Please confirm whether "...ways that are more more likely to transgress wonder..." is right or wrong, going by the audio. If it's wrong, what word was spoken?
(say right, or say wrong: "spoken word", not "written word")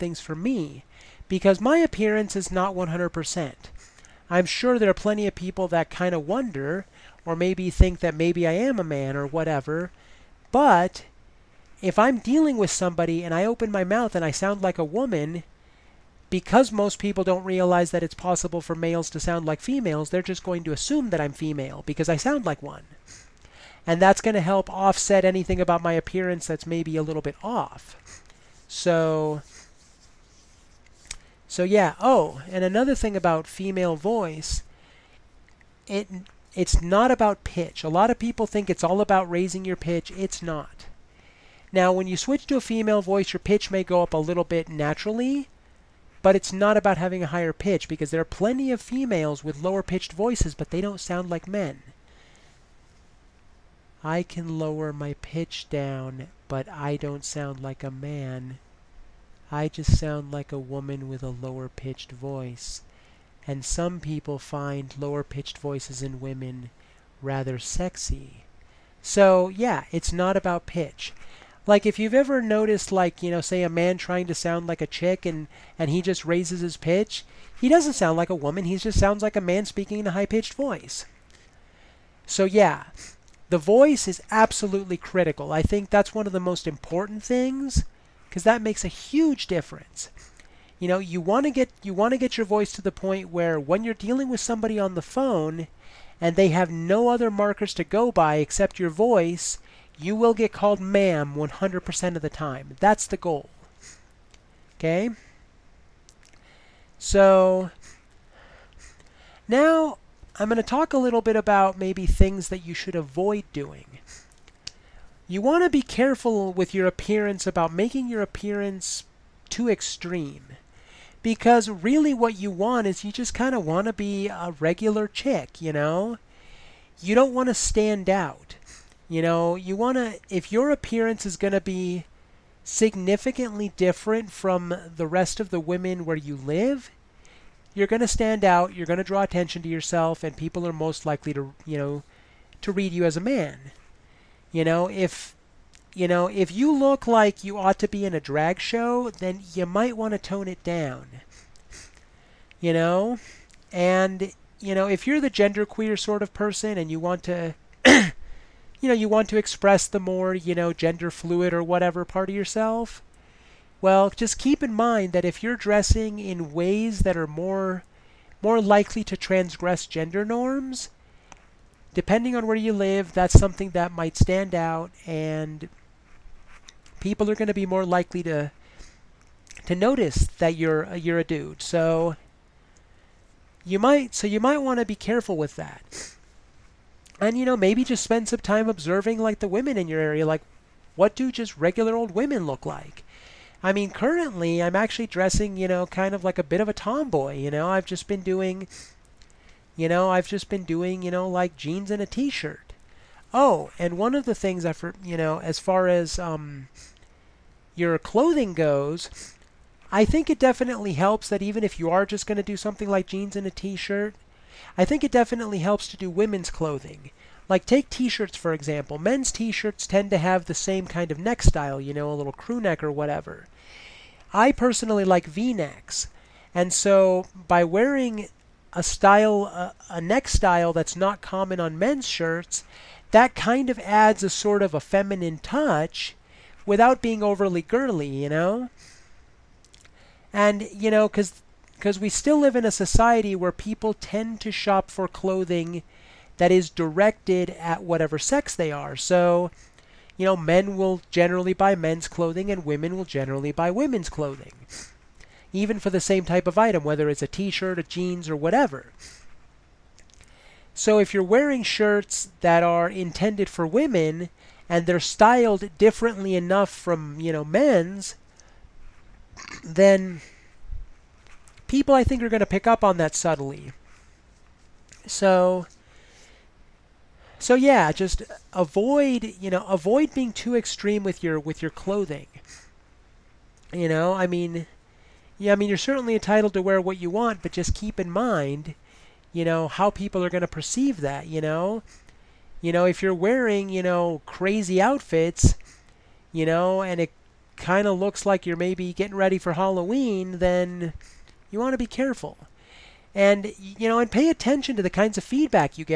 wrong: "gender", not "wonder".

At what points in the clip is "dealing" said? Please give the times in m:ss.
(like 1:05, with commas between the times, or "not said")
0:12, 1:33.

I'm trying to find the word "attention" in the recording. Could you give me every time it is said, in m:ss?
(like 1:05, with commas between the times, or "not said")
2:19, 5:04.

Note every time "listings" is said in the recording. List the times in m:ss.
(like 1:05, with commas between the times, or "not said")
not said.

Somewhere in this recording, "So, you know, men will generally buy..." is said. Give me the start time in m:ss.
4:08.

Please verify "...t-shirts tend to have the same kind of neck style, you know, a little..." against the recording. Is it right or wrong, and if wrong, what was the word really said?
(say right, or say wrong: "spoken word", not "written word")
right.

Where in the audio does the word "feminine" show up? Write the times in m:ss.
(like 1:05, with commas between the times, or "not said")
3:54.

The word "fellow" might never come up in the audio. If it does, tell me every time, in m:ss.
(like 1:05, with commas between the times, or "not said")
not said.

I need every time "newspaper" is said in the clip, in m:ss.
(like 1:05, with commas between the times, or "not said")
not said.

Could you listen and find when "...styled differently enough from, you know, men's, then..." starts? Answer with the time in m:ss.
4:24.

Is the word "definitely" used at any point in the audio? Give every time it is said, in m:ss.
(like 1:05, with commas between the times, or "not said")
3:30, 3:35.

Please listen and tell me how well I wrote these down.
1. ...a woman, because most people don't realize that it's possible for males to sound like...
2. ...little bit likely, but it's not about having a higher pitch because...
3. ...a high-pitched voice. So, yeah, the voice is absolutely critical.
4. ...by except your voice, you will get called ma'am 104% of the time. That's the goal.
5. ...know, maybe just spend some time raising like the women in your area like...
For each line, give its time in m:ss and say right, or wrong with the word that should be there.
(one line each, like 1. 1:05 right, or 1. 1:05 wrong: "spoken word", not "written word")
1. 0:14 right
2. 0:44 wrong: "naturally", not "likely"
3. 1:20 right
4. 1:38 wrong: "100", not "104"
5. 3:07 wrong: "observing", not "raising".